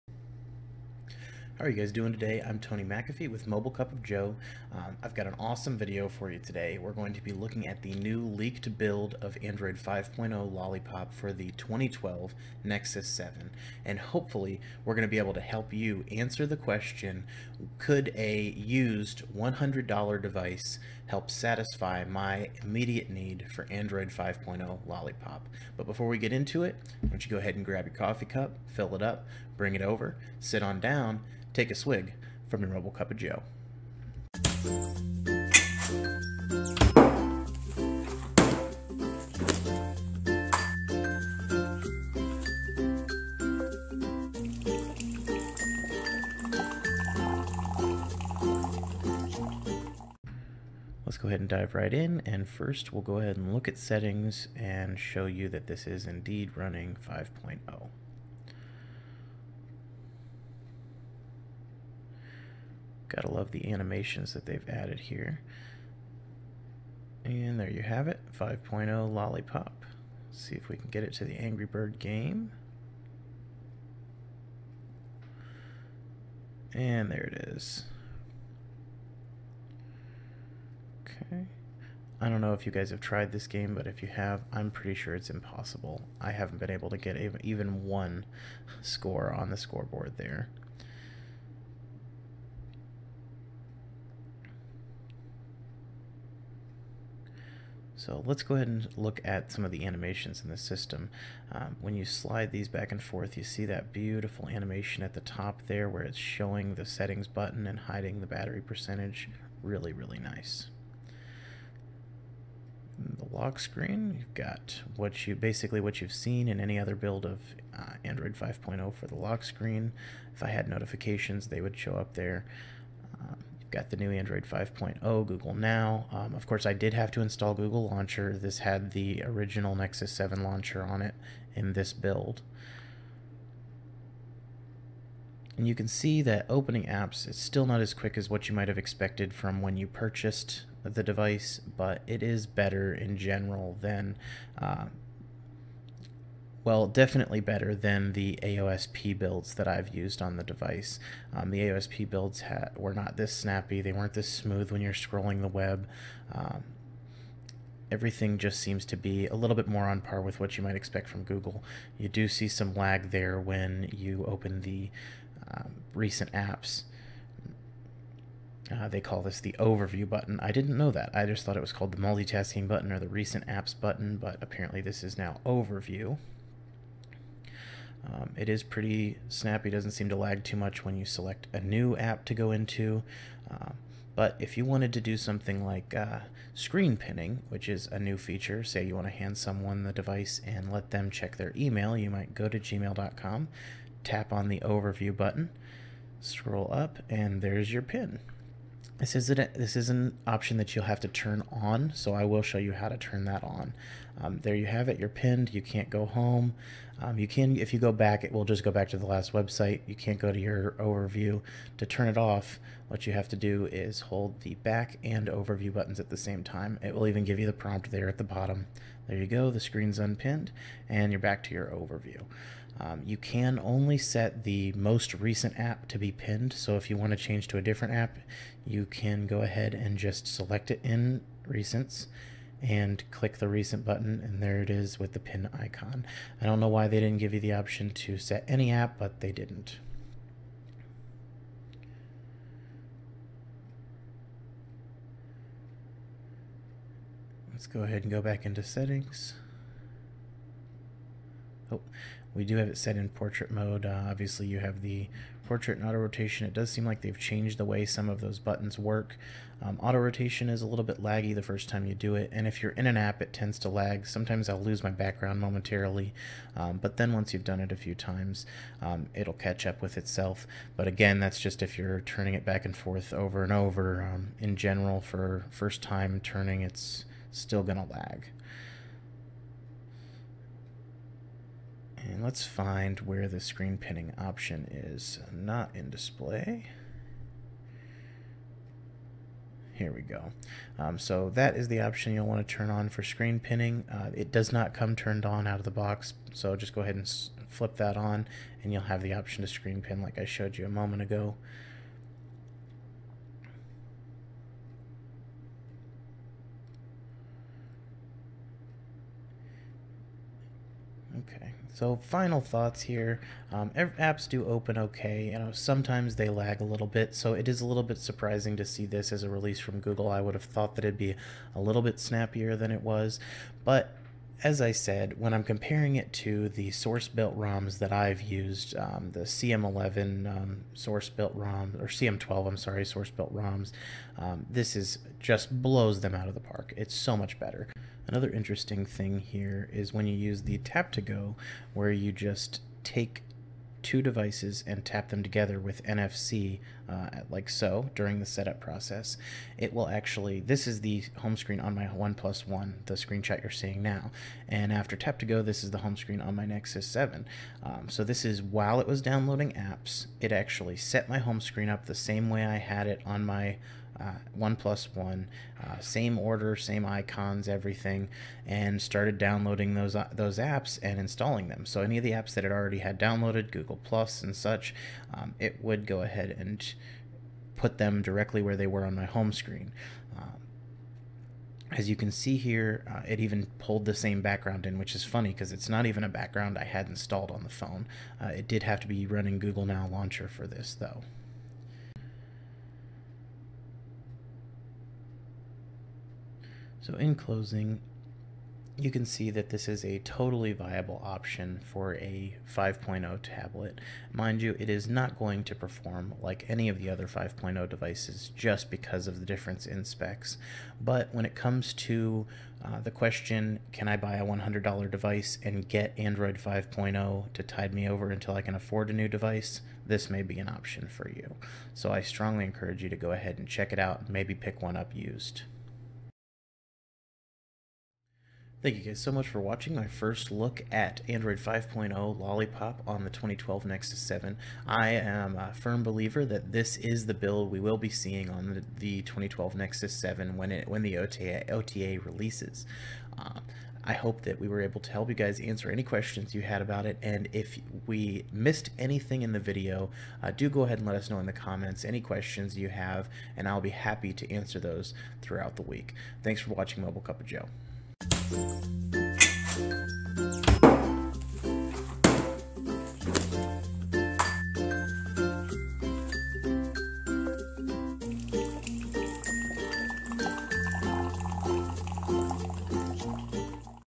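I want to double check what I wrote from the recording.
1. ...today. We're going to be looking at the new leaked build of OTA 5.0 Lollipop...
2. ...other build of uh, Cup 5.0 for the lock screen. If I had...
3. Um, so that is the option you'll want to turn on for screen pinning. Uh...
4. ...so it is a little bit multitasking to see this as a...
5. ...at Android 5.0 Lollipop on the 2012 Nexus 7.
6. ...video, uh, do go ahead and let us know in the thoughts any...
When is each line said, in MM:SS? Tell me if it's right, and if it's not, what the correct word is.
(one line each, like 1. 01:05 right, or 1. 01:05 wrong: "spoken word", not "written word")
1. 00:06 wrong: "Android", not "OTA"
2. 01:56 wrong: "Android", not "Cup"
3. 04:50 right
4. 05:17 wrong: "surprising", not "multitasking"
5. 07:10 right
6. 07:29 wrong: "comments", not "thoughts".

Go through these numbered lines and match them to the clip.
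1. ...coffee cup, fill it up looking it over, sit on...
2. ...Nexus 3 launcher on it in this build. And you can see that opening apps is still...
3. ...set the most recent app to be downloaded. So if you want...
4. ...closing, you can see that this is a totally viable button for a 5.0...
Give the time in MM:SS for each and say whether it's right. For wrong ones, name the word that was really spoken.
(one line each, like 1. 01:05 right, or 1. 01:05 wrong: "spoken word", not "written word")
1. 00:27 wrong: "bring", not "looking"
2. 02:09 wrong: "7", not "3"
3. 03:43 wrong: "pinned", not "downloaded"
4. 06:37 wrong: "option", not "button".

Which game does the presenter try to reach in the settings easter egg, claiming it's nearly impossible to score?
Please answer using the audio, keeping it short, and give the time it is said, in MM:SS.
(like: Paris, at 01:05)
Angry Bird, at 01:11.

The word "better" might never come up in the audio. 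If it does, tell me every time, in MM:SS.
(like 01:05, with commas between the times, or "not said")
02:22, 02:27, 05:37.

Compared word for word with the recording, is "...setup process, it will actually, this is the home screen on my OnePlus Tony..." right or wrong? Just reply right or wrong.
wrong.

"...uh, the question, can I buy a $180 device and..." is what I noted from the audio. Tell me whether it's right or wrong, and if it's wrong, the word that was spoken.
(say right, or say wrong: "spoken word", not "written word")
wrong: "100", not "180".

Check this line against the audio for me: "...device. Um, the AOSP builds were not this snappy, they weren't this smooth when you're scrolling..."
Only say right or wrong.
right.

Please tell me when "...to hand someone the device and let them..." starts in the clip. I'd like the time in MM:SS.
03:09.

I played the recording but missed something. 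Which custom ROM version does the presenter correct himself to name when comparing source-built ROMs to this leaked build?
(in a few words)
CM12.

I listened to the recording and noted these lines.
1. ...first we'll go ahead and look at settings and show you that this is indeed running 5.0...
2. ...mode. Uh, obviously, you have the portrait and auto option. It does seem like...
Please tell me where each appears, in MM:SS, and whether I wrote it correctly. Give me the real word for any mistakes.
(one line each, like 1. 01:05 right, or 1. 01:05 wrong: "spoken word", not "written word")
1. 00:52 right
2. 04:13 wrong: "rotation", not "option".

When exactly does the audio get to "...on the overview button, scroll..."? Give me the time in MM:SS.
03:14.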